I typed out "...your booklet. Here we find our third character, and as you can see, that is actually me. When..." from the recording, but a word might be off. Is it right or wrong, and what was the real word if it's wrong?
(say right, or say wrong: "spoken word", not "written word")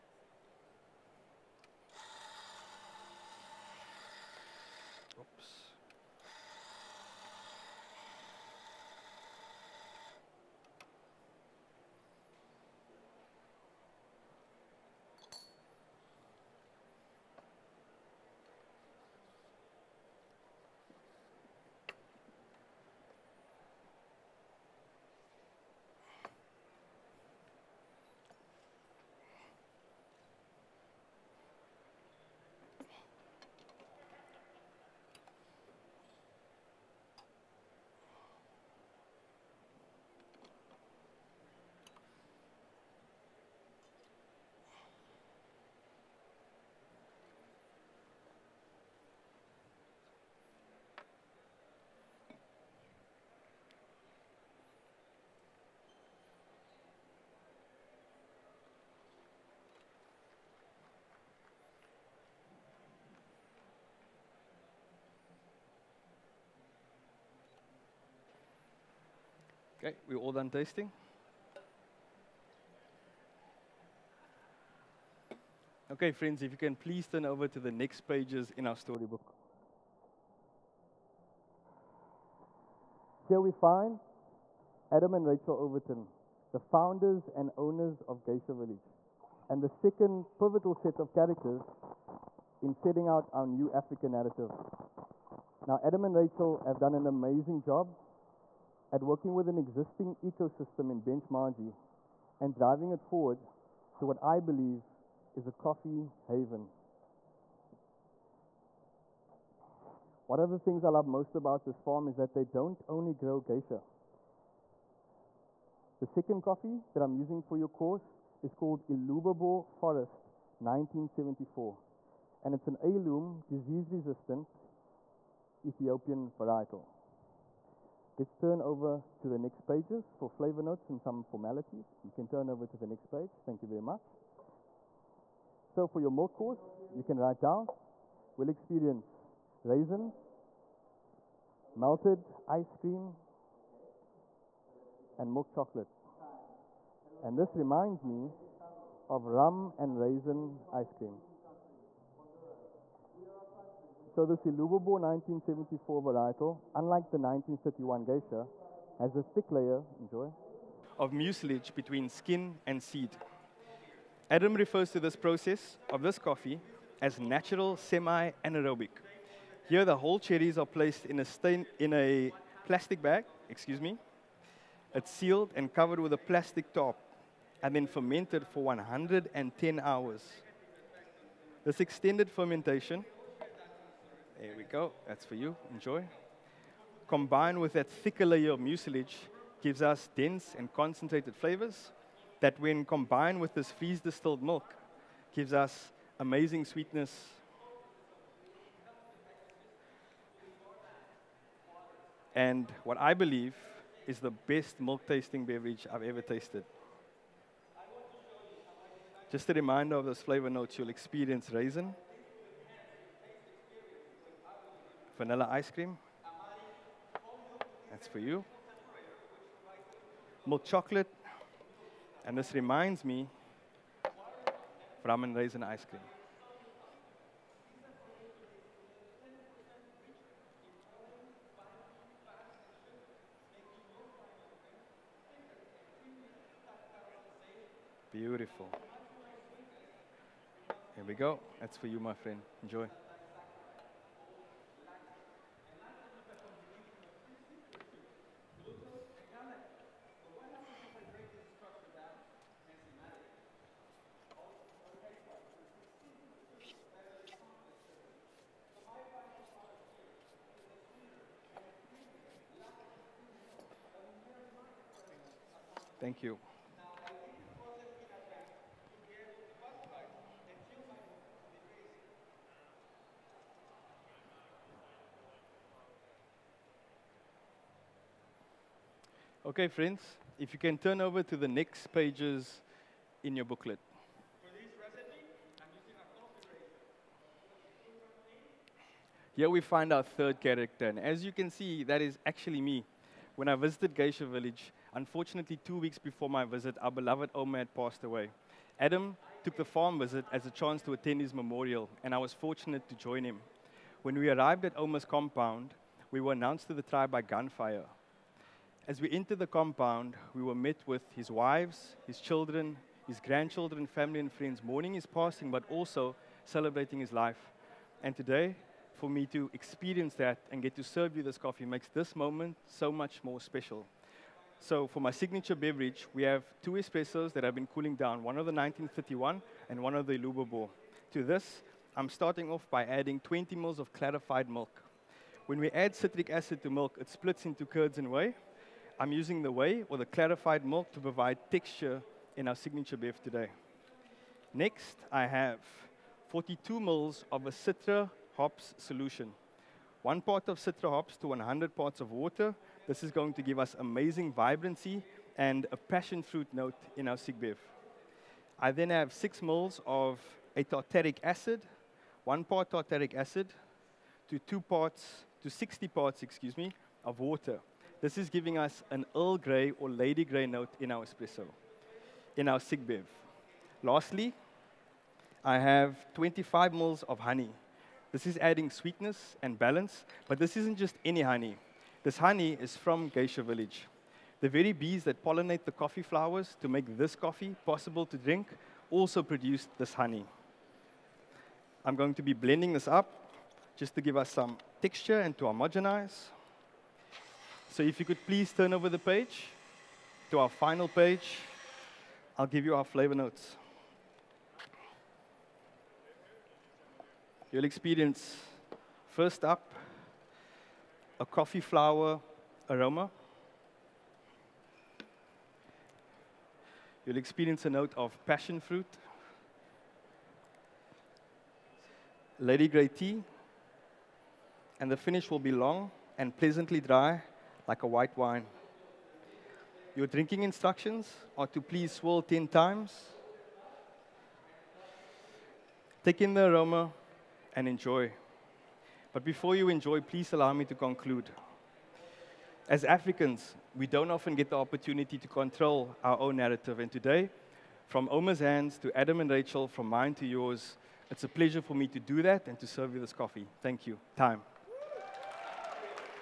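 right.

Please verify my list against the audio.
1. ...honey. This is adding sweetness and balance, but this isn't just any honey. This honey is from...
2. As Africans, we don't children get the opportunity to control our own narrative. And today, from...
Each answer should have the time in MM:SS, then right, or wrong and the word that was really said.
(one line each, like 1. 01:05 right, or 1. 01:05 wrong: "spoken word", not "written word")
1. 06:17 right
2. 07:22 wrong: "often", not "children".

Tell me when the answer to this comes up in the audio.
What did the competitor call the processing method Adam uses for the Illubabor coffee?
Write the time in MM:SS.
02:47.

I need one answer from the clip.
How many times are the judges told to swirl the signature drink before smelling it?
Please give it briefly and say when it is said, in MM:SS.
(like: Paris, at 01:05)
10, at 07:12.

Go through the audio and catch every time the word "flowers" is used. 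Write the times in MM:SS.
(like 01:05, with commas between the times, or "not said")
06:26, 06:51.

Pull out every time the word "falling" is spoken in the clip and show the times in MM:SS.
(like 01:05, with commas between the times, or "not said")
not said.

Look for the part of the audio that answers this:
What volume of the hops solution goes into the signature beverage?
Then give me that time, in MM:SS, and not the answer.
05:46.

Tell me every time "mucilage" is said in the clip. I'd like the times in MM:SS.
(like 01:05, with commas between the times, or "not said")
02:41, 03:08.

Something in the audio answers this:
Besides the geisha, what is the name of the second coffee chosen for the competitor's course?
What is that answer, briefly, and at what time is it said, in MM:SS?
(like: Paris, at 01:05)
Illubabor Forest 1974, at 01:58.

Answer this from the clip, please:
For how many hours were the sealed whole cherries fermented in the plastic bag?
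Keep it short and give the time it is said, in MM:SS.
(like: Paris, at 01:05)
110, at 02:58.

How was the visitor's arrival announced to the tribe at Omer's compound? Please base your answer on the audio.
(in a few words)
By gunfire.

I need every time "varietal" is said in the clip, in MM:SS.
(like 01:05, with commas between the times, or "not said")
02:06, 02:36.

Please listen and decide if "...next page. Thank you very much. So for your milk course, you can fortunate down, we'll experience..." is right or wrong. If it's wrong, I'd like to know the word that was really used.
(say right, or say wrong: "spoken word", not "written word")
wrong: "write", not "fortunate".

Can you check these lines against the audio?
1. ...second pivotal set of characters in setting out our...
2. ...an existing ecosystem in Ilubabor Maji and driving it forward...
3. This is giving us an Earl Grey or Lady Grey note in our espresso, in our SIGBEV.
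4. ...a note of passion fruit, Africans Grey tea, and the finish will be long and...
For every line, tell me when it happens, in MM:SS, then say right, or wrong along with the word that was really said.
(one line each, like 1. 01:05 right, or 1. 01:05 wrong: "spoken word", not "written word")
1. 01:29 right
2. 01:39 wrong: "Bench", not "Ilubabor"
3. 06:08 right
4. 06:57 wrong: "Lady", not "Africans".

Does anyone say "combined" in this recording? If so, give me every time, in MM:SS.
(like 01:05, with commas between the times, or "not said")
03:07, 03:12.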